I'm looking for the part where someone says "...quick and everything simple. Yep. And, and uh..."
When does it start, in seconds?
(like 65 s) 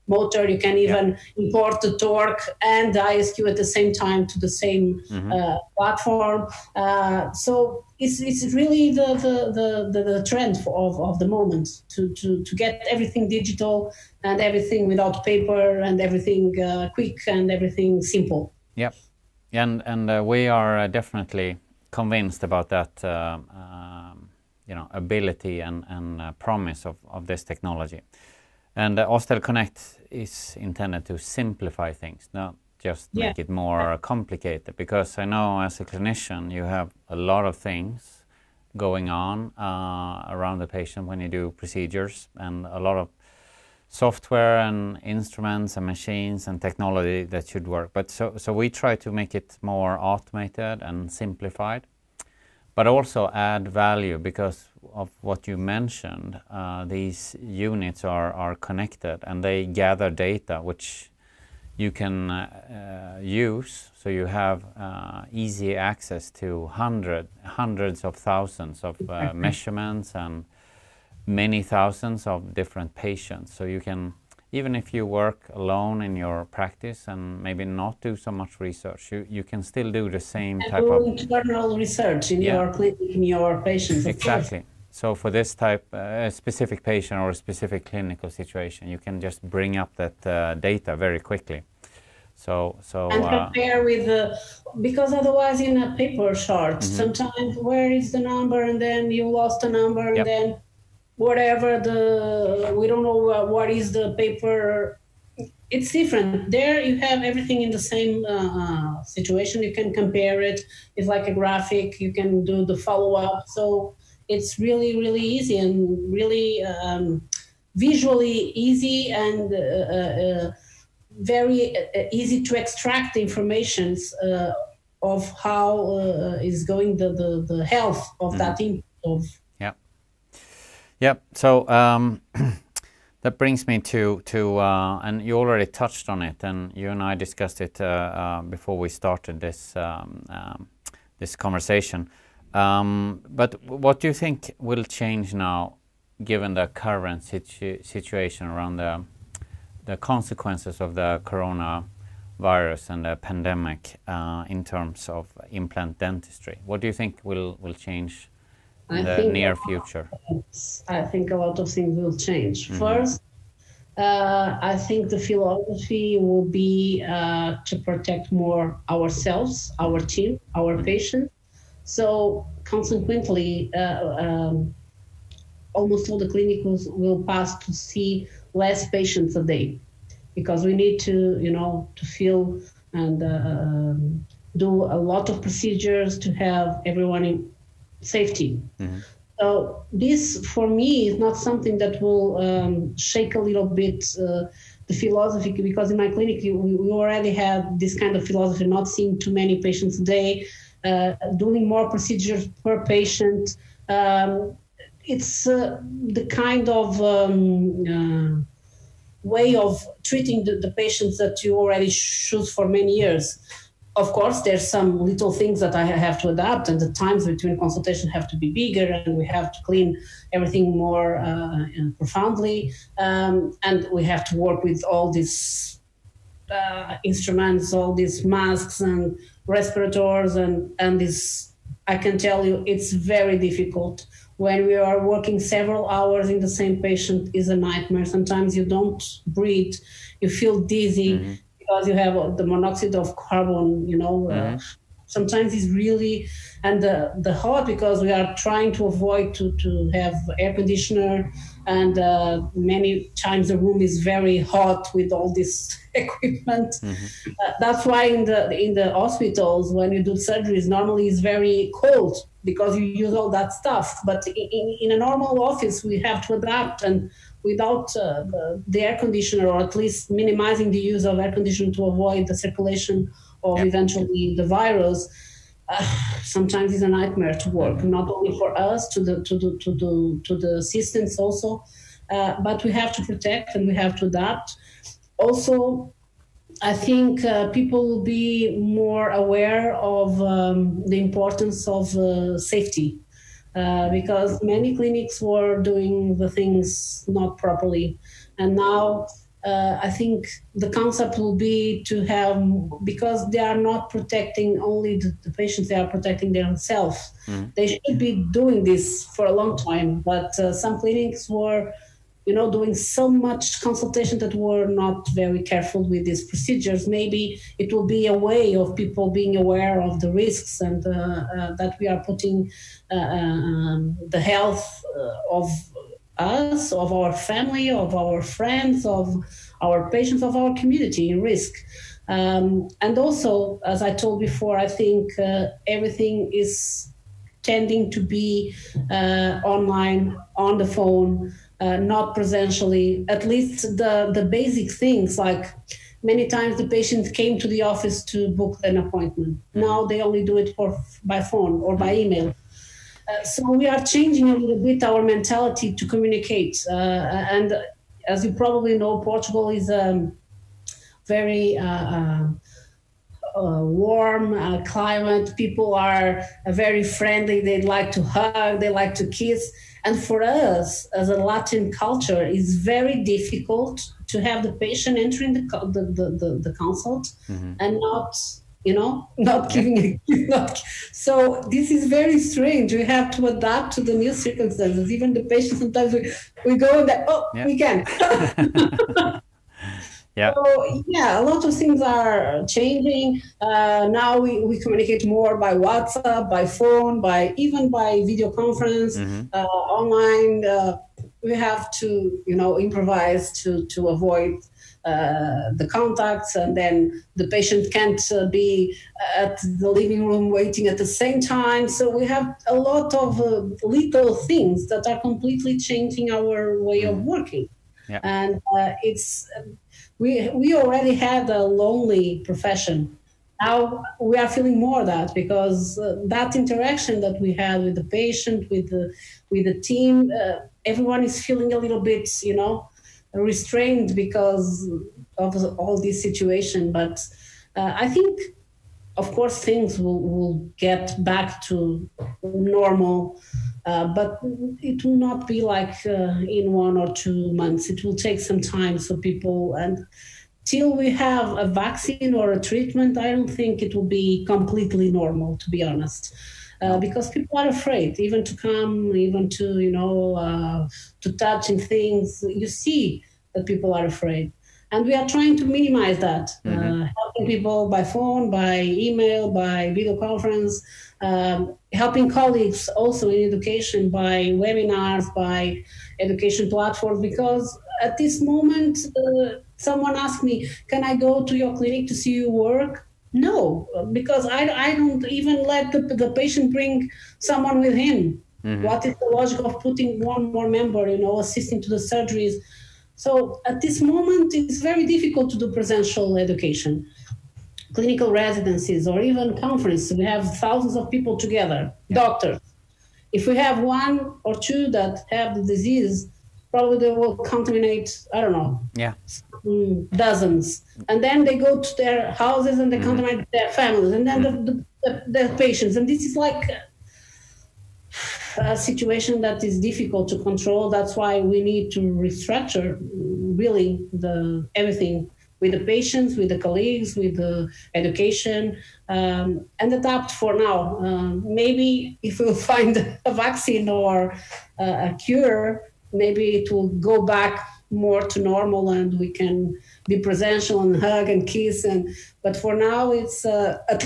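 16 s.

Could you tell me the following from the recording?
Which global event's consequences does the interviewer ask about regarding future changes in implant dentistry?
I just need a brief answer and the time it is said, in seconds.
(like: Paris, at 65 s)
coronavirus, at 151 s.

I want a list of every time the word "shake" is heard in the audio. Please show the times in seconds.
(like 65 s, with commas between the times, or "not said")
192 s.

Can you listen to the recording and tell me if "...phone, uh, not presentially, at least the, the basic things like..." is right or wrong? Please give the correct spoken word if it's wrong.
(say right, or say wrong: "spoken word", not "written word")
right.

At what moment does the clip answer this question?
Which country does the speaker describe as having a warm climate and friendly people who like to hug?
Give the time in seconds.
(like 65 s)
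359 s.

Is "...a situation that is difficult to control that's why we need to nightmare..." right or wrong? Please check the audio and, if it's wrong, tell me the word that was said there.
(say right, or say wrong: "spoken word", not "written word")
wrong: "restructure", not "nightmare".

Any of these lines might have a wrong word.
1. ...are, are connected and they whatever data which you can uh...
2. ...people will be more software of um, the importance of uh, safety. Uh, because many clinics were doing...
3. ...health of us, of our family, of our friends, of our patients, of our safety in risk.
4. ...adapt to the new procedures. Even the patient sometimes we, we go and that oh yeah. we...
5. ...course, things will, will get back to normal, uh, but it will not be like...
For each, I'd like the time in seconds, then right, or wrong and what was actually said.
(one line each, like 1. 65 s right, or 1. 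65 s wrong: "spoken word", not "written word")
1. 58 s wrong: "gather", not "whatever"
2. 287 s wrong: "aware", not "software"
3. 324 s wrong: "community", not "safety"
4. 383 s wrong: "circumstances", not "procedures"
5. 439 s right.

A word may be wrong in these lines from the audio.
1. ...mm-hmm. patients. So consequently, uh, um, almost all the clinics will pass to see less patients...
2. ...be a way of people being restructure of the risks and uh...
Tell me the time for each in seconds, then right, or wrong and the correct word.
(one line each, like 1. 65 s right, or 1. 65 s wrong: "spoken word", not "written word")
1. 170 s right
2. 317 s wrong: "aware", not "restructure".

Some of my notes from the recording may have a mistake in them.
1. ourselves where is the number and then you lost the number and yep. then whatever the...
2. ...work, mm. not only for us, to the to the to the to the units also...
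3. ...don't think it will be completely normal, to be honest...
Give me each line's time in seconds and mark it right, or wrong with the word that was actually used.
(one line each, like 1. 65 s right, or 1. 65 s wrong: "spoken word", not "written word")
1. 97 s wrong: "sometimes", not "ourselves"
2. 277 s wrong: "assistants", not "units"
3. 453 s right.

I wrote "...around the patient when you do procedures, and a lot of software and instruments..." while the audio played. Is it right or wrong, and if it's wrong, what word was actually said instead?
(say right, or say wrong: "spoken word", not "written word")
right.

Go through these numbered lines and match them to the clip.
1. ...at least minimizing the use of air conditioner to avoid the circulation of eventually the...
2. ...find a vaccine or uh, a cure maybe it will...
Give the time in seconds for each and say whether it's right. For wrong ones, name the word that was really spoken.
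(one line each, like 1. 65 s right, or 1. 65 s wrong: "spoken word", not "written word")
1. 269 s right
2. 532 s right.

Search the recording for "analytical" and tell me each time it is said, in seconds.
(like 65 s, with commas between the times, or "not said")
not said.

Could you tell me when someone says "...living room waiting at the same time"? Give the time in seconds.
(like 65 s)
409 s.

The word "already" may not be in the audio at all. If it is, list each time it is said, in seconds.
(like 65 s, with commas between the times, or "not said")
135 s, 196 s, 211 s, 420 s.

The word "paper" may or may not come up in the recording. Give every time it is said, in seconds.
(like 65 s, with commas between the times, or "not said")
15 s, 95 s, 104 s.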